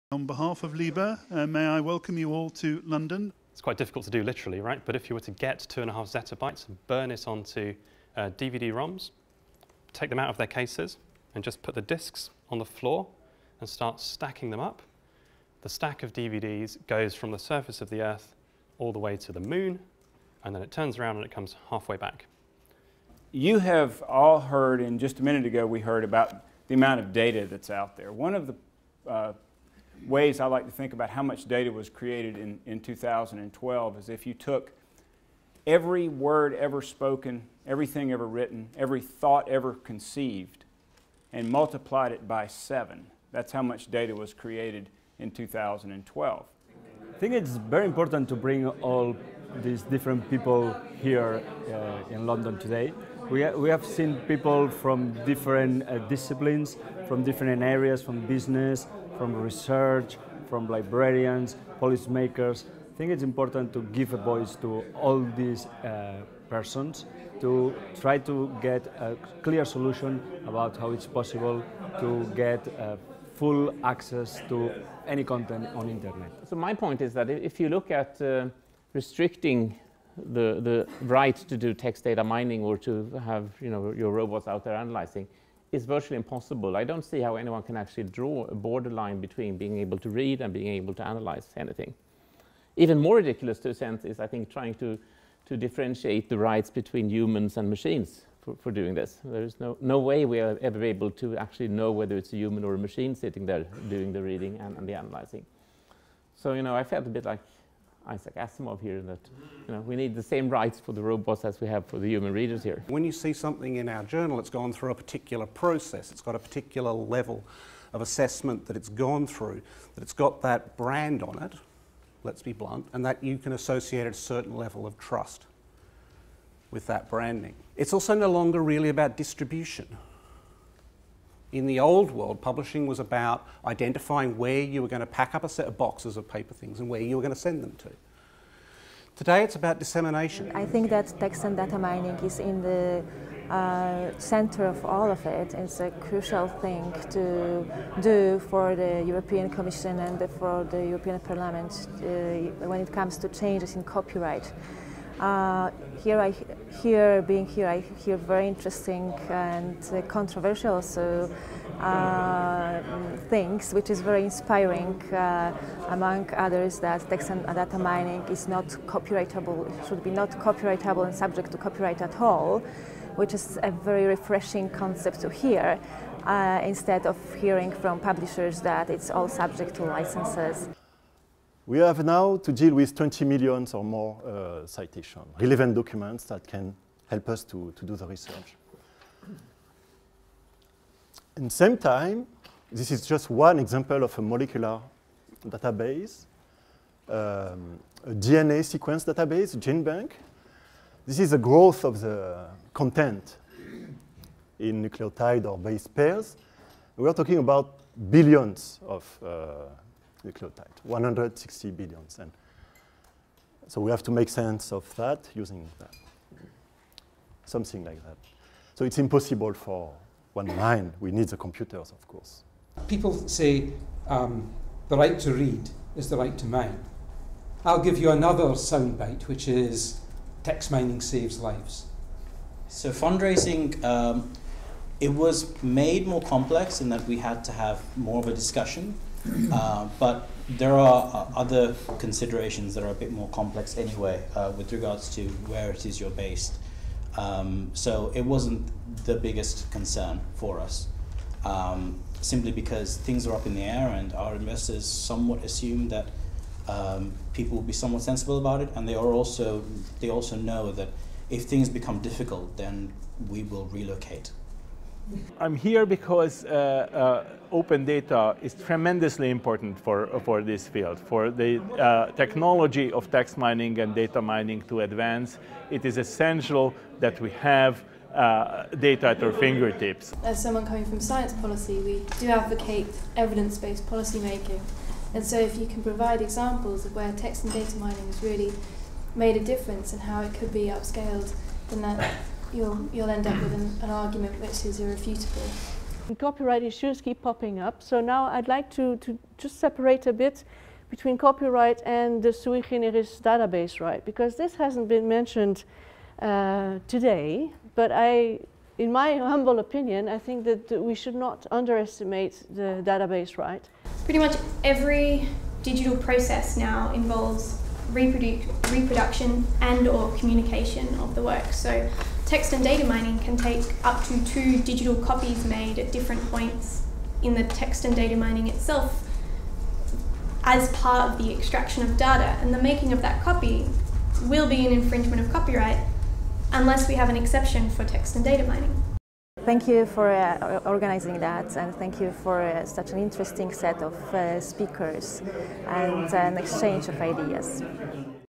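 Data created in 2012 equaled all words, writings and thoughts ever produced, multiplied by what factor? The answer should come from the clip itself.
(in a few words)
7.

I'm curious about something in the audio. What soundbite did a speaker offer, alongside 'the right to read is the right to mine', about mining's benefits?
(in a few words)
text mining saves lives.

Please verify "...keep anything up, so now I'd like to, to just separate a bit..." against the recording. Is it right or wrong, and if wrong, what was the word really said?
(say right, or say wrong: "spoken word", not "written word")
wrong: "popping", not "anything".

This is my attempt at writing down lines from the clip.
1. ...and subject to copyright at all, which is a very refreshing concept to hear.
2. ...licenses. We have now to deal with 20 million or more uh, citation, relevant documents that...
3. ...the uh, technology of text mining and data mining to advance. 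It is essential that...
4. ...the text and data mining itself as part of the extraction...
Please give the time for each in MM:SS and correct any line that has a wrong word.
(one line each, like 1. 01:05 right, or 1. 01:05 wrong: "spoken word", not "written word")
1. 02:51 right
2. 02:59 right
3. 04:31 right
4. 05:27 right.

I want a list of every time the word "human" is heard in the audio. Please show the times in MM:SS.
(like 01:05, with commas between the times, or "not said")
01:37, 01:42, 01:52.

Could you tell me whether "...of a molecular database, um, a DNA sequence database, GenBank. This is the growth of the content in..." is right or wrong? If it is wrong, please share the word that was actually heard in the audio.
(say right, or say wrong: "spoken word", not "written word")
right.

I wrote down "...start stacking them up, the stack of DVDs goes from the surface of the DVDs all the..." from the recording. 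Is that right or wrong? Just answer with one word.
wrong.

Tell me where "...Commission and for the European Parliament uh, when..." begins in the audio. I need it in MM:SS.
02:29.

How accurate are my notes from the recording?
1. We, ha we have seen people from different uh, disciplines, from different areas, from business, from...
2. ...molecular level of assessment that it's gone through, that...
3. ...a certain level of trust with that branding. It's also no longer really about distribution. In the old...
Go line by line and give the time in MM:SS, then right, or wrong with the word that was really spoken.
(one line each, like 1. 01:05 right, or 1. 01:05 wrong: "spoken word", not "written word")
1. 00:53 right
2. 01:56 wrong: "particular", not "molecular"
3. 02:04 right.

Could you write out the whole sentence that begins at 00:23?
You have all heard, and just a minute ago we heard about the amount of data that's out there.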